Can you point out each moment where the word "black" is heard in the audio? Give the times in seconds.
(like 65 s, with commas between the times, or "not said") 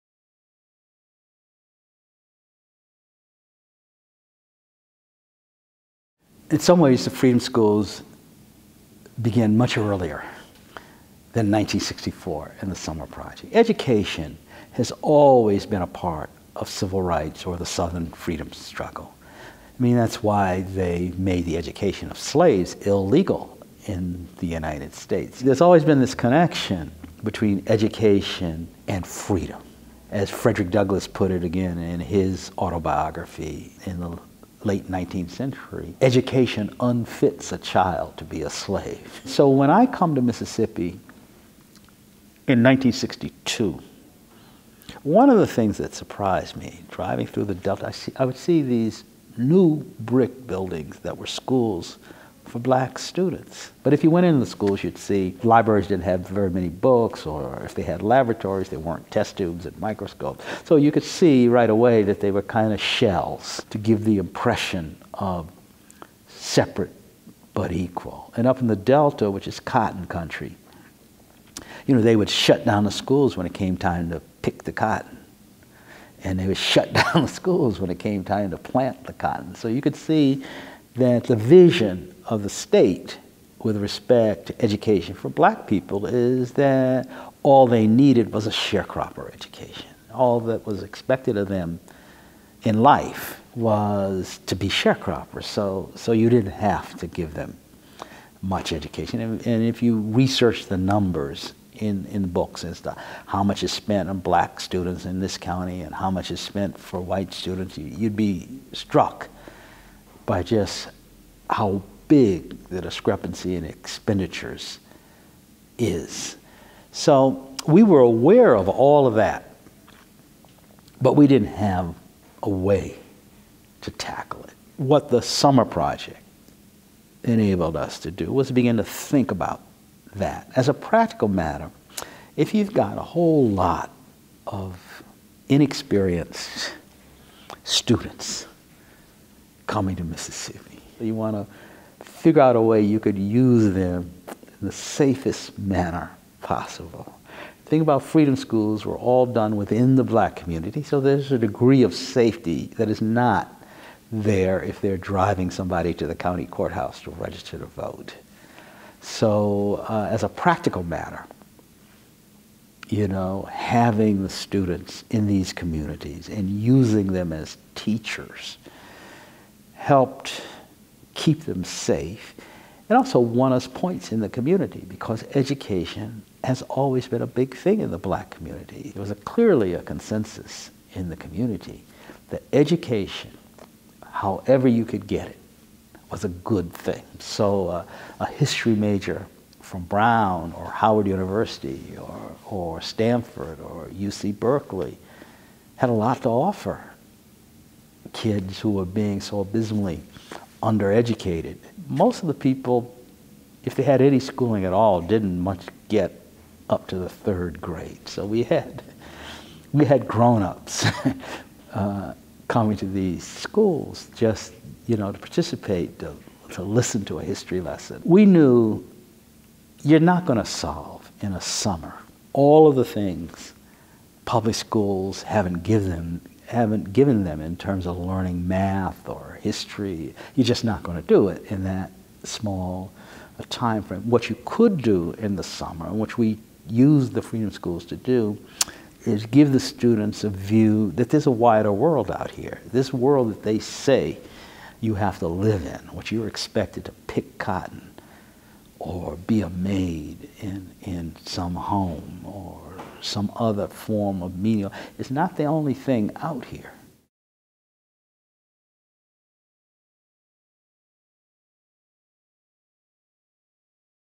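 52 s, 85 s, 104 s, 150 s, 177 s.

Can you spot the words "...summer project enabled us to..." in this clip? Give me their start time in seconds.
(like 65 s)
125 s.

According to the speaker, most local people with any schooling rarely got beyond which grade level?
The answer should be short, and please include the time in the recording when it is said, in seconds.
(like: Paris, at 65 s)
third grade, at 207 s.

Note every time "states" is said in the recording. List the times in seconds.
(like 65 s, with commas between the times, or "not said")
24 s, 82 s.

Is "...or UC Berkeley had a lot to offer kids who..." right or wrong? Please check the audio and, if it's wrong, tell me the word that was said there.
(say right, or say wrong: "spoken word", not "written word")
right.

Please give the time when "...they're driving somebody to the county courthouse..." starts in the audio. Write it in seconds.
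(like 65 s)
154 s.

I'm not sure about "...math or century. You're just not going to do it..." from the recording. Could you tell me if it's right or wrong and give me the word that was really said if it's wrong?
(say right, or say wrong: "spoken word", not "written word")
wrong: "history", not "century".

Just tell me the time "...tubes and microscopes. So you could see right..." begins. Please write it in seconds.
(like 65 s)
59 s.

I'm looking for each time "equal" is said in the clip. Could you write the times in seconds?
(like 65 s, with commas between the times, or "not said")
67 s.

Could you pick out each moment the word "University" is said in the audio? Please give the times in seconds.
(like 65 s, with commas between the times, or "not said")
191 s.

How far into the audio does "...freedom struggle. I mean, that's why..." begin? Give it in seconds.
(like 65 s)
18 s.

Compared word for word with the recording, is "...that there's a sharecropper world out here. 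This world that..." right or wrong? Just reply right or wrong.
wrong.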